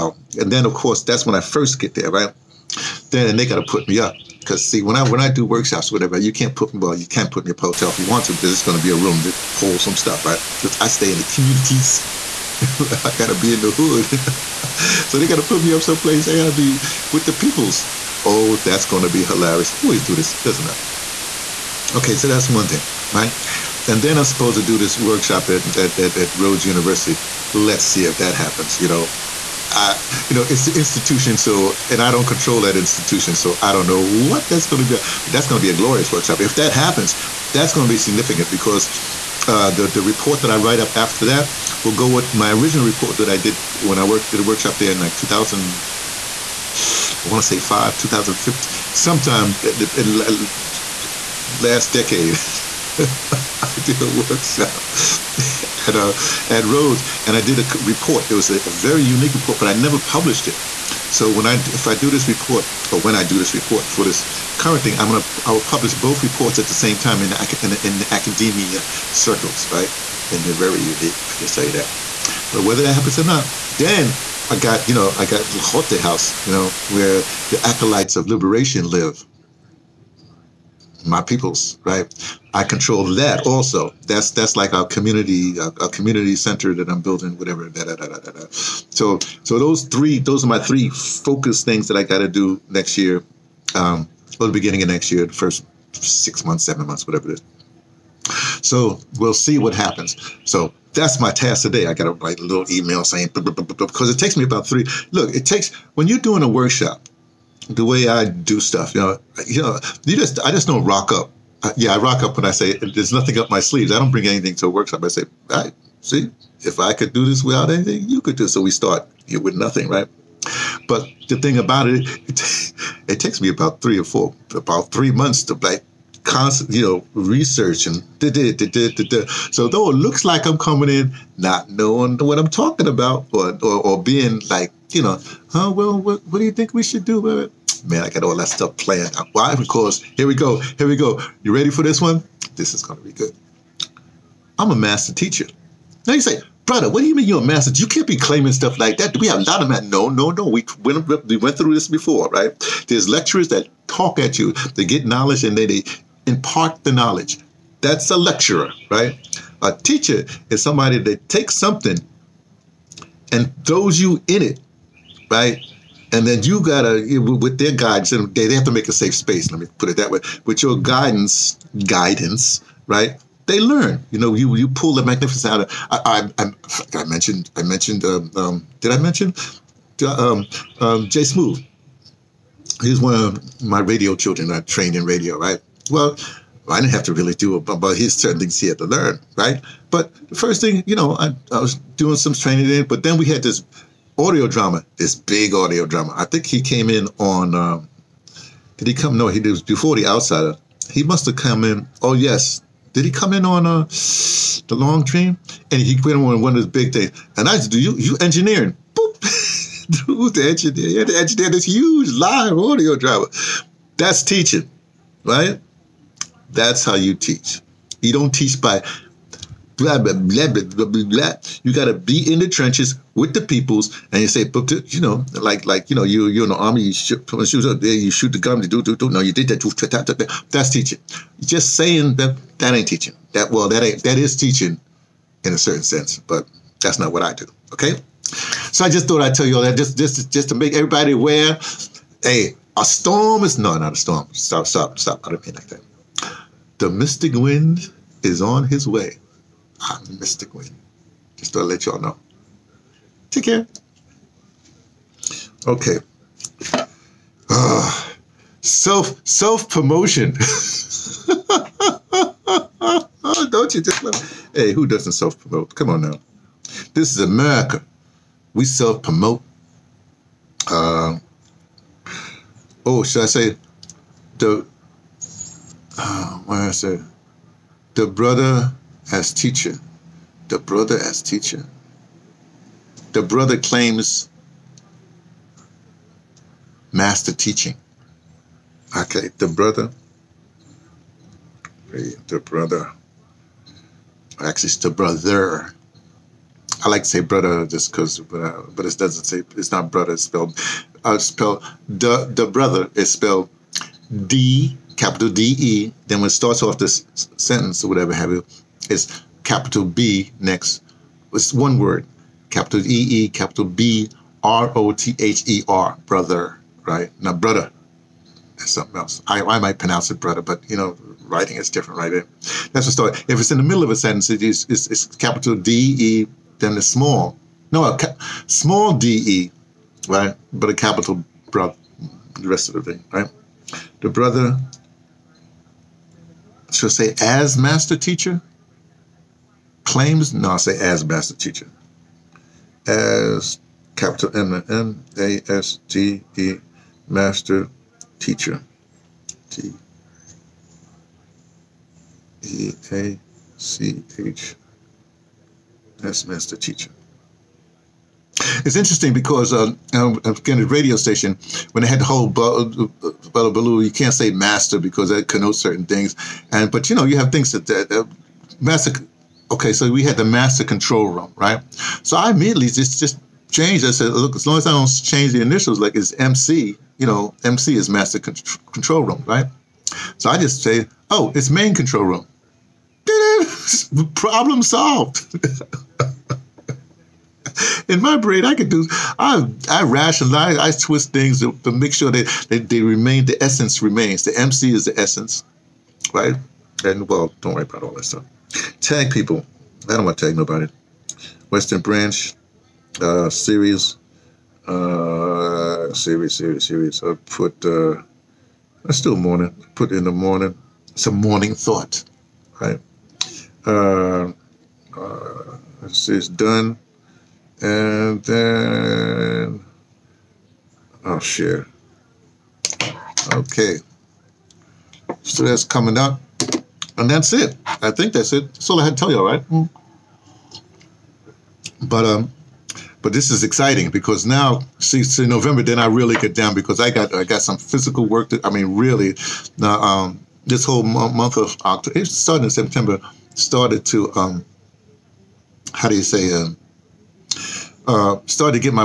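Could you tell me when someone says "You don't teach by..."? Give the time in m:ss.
3:38.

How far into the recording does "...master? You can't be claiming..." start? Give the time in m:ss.
2:27.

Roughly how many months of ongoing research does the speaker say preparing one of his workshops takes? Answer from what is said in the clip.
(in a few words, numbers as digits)
3 months.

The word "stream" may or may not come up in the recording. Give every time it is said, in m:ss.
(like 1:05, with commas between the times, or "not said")
not said.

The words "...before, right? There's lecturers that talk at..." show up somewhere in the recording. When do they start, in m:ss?
2:31.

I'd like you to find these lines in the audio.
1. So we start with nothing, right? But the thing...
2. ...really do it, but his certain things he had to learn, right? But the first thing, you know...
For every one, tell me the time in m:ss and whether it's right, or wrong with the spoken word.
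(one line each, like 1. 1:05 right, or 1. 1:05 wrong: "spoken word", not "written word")
1. 1:58 right
2. 3:07 right.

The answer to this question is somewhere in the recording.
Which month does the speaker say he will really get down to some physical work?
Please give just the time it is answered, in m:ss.
7:15.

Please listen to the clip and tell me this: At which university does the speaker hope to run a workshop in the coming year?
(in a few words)
Rhodes University.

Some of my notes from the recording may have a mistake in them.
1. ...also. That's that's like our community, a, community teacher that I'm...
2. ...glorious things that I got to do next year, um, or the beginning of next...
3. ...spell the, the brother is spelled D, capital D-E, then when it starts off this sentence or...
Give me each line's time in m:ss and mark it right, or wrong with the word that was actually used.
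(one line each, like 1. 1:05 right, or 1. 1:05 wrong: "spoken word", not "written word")
1. 1:23 wrong: "center", not "teacher"
2. 1:30 wrong: "focus", not "glorious"
3. 5:01 right.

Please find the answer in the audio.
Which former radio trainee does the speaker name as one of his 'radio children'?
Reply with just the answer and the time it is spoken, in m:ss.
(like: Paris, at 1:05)
Jay Smooth, at 3:01.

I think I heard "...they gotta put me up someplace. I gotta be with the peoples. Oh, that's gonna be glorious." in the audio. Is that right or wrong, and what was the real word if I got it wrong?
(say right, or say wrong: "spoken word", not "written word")
wrong: "hilarious", not "glorious".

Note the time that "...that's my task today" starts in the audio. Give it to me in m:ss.
1:40.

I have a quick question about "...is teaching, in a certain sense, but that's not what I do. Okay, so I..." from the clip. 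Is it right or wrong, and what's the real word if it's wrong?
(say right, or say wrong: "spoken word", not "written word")
right.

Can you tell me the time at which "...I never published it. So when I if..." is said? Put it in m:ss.
0:59.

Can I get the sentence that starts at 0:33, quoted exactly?
So I don't know what that's going to be.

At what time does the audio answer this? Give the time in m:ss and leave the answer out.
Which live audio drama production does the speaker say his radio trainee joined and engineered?
3:24.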